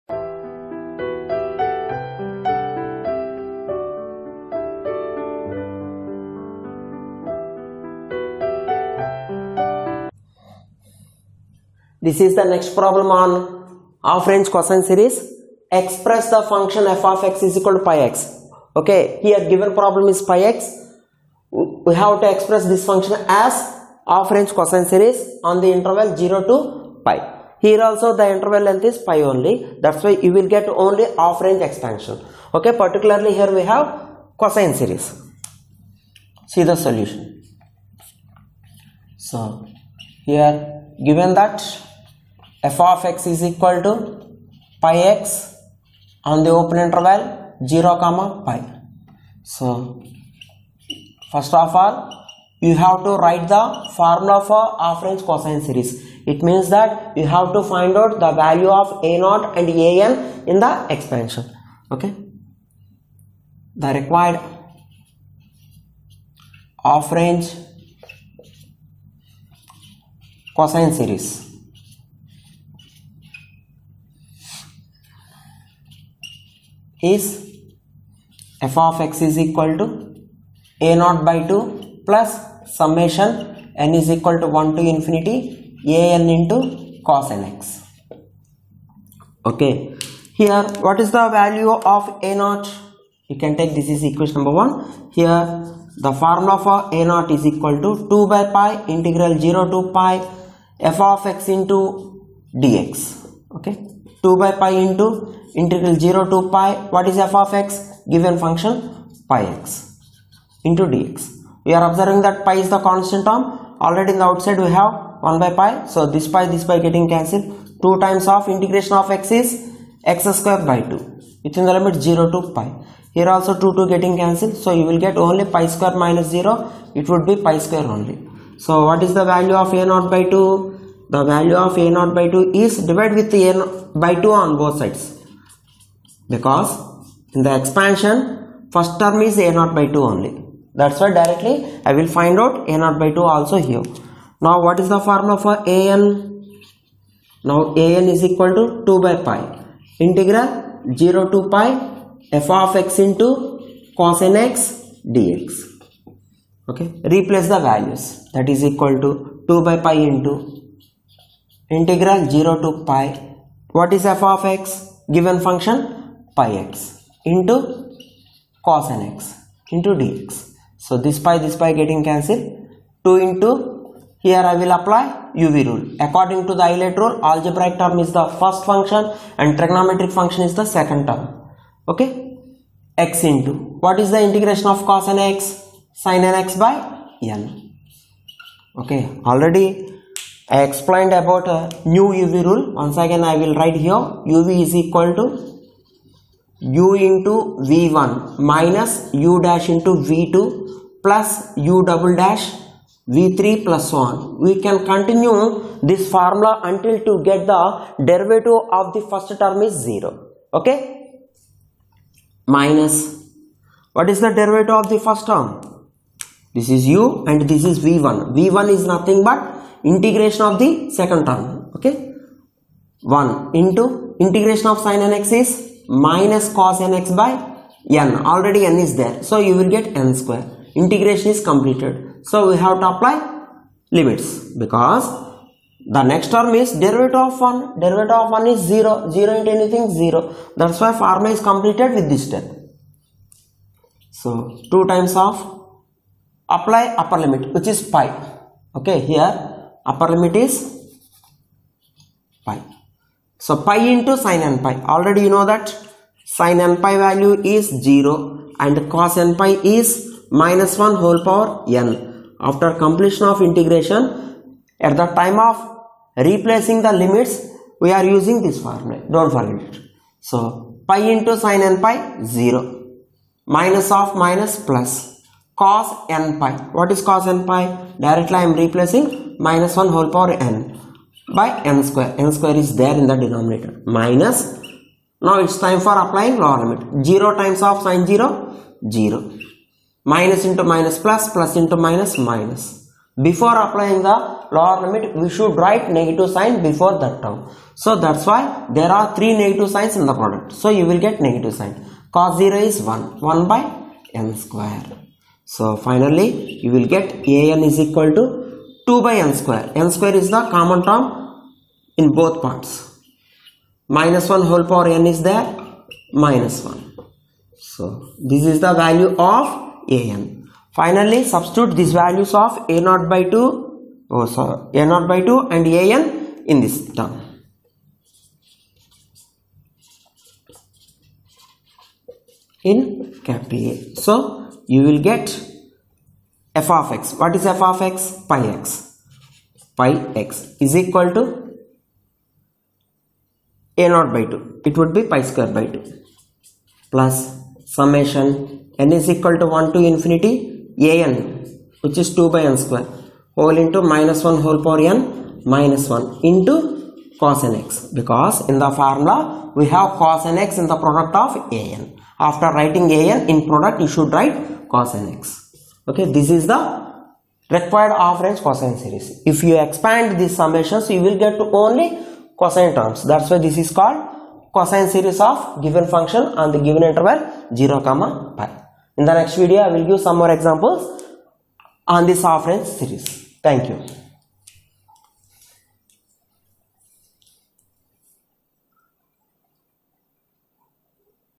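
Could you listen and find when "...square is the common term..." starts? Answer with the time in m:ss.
5:09.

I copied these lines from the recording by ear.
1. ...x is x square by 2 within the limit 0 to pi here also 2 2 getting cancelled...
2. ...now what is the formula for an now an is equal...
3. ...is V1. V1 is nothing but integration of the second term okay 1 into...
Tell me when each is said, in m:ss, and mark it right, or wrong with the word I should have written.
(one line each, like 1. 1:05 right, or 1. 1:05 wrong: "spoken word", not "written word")
1. 1:59 right
2. 2:24 right
3. 3:37 right.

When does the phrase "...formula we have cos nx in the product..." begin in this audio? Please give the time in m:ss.
5:58.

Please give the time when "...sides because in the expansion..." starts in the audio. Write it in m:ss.
2:14.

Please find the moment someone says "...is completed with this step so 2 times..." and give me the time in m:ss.
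4:01.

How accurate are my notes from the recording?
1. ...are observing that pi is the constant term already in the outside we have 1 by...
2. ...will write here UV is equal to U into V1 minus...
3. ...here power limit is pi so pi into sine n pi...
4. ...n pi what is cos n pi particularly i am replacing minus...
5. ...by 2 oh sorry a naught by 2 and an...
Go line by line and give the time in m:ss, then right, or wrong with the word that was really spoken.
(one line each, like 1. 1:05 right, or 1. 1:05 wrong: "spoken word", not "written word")
1. 1:51 right
2. 3:13 right
3. 4:09 wrong: "upper", not "power"
4. 4:36 wrong: "directly", not "particularly"
5. 5:23 right.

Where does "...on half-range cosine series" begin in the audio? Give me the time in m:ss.
0:13.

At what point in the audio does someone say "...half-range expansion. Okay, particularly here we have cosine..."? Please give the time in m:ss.
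0:31.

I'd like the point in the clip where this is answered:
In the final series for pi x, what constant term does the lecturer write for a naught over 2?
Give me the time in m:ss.
5:45.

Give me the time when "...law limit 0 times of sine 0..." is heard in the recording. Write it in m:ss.
4:46.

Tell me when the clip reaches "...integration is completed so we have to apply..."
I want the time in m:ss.
3:50.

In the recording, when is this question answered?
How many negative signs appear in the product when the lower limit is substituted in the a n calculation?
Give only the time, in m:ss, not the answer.
4:59.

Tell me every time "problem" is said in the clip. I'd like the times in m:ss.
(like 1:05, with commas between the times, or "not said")
0:12, 0:19.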